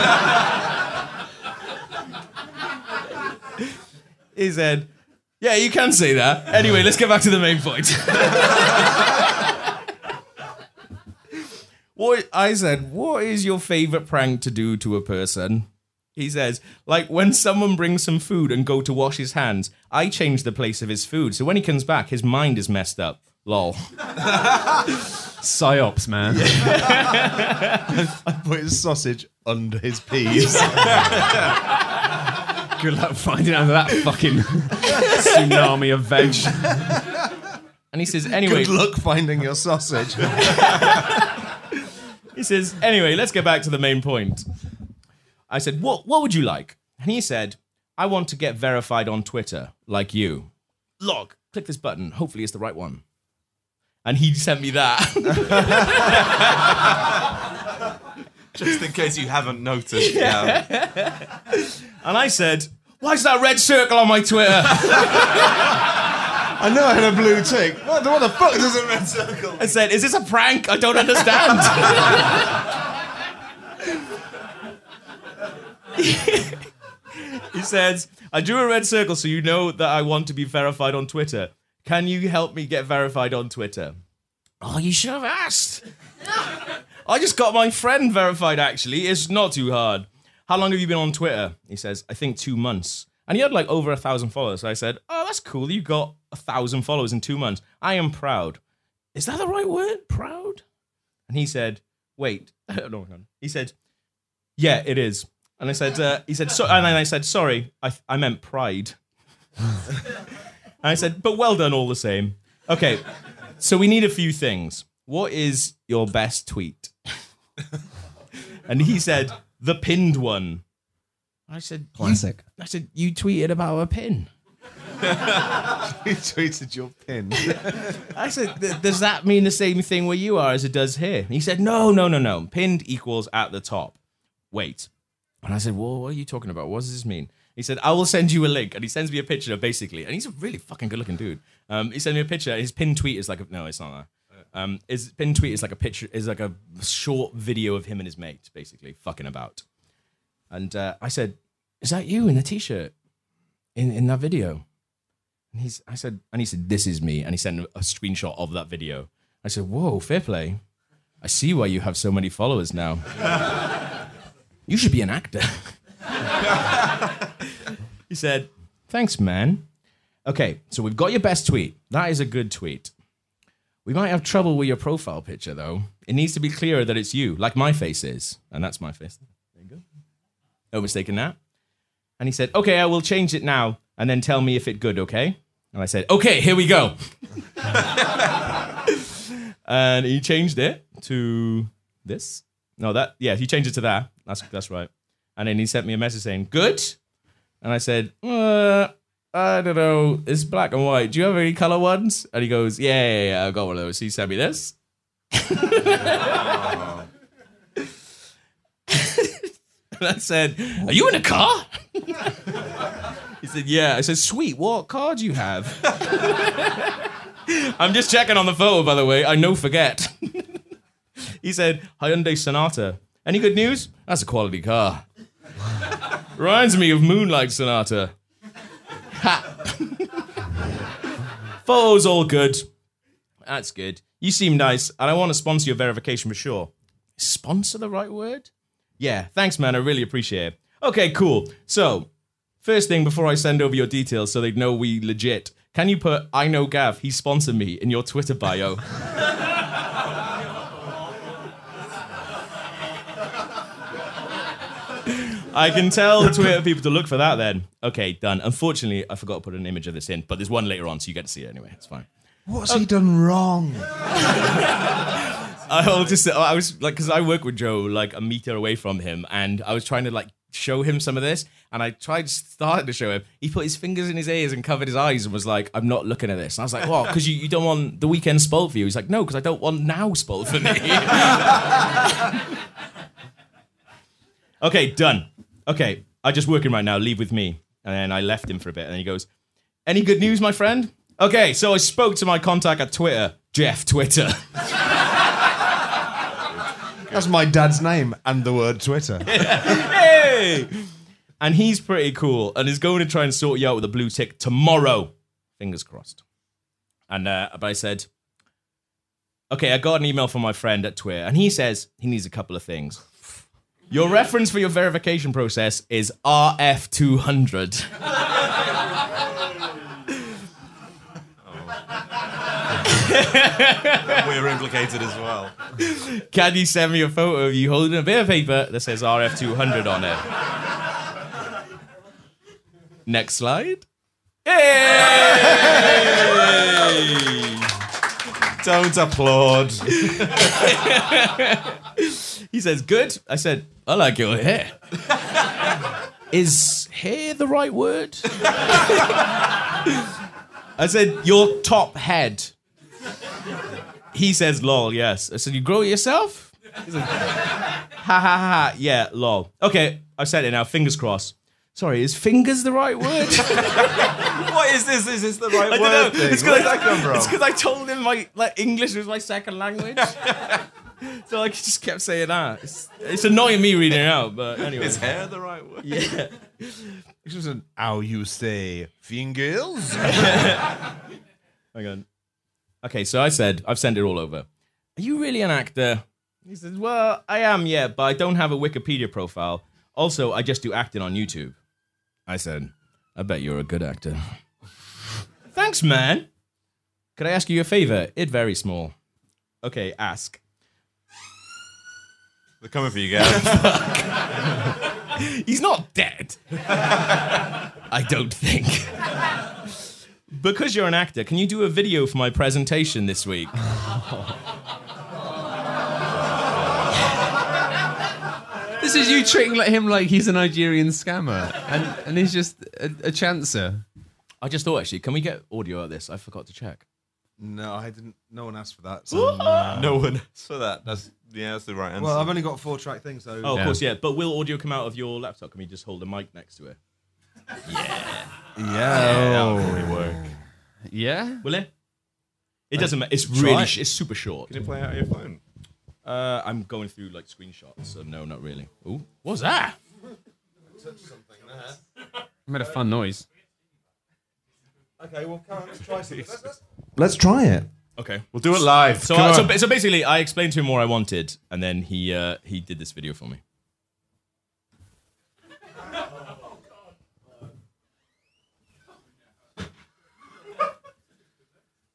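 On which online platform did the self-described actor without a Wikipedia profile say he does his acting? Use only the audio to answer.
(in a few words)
YouTube.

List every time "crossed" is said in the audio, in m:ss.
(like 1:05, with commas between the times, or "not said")
5:05, 6:00.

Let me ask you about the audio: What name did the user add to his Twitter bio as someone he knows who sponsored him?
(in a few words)
Gav.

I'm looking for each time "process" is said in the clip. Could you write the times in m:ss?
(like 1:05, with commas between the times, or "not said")
5:15.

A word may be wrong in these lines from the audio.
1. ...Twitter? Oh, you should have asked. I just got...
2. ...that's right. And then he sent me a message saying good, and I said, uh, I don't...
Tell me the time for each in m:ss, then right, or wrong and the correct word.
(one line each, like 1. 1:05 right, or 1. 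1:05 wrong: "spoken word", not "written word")
1. 1:23 right
2. 3:14 right.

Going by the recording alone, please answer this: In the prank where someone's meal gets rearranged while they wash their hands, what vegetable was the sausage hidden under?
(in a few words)
peas.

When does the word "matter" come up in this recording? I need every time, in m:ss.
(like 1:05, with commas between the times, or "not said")
7:22.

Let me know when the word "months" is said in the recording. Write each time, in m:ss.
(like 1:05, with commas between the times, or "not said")
1:32, 1:37.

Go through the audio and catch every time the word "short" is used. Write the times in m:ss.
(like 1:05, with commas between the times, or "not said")
2:26, 7:24.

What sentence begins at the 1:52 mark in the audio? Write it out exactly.
Okay, so we need a few things.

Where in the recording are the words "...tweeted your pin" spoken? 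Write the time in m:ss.
2:06.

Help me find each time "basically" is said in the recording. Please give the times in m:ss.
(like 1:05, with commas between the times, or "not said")
2:19, 2:28, 7:39.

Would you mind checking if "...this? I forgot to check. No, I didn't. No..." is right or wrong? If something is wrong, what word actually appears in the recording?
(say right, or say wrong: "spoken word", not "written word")
right.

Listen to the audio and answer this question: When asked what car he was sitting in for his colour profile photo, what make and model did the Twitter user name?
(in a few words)
Hyundai Sonata.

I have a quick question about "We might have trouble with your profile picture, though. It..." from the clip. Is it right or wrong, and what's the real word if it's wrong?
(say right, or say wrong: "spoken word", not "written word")
right.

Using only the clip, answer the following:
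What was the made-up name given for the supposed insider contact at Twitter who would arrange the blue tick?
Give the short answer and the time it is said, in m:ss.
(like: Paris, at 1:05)
Jeff Twitter, at 4:53.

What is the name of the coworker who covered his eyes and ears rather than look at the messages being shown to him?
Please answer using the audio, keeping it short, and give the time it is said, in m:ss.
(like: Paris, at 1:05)
Joe, at 4:27.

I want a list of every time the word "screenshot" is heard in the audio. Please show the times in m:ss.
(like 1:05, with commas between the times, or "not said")
2:37, 7:27.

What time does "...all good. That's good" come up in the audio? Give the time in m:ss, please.
3:52.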